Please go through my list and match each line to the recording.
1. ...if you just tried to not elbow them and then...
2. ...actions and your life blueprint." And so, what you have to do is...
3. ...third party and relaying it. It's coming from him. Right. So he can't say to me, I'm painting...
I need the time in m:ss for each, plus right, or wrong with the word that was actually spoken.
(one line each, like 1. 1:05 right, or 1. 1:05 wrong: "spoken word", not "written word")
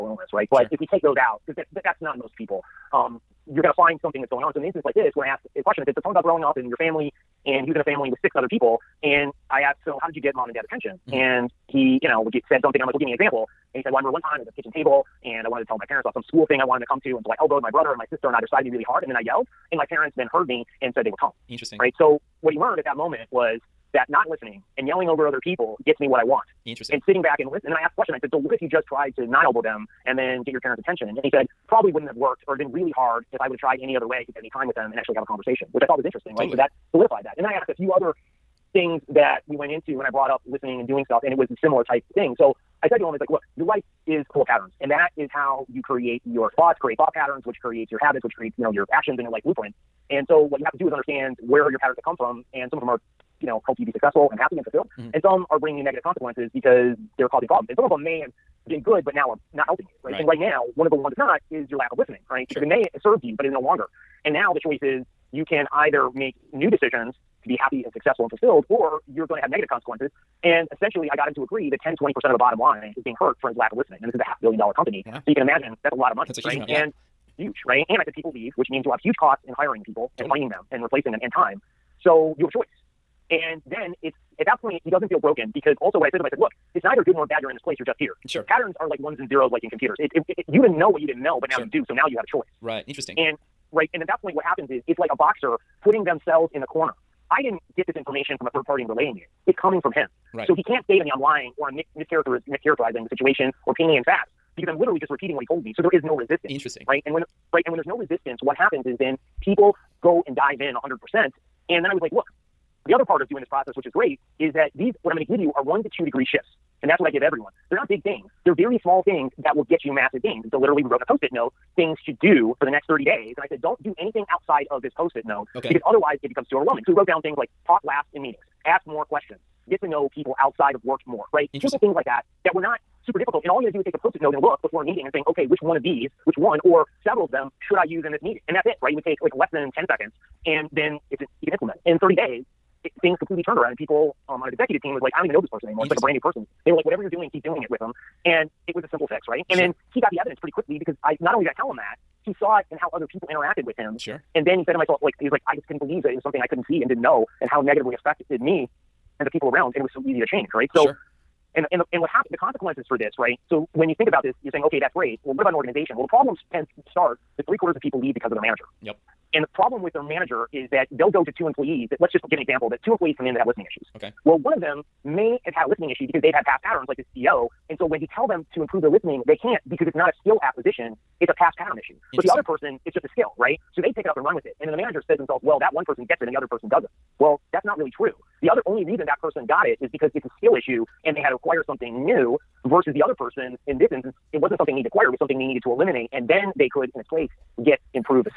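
1. 0:28 right
2. 0:48 right
3. 1:38 wrong: "lying", not "painting".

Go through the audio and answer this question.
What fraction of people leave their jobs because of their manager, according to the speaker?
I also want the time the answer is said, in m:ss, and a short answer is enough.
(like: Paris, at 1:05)
three quarters, at 2:47.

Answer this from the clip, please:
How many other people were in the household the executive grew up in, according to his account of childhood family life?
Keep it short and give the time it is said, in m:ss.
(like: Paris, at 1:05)
6, at 0:08.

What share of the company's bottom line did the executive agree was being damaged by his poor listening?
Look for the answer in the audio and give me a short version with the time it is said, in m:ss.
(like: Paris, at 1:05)
10 to 20 percent, at 1:11.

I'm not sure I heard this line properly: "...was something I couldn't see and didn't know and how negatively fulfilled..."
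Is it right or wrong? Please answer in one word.
wrong.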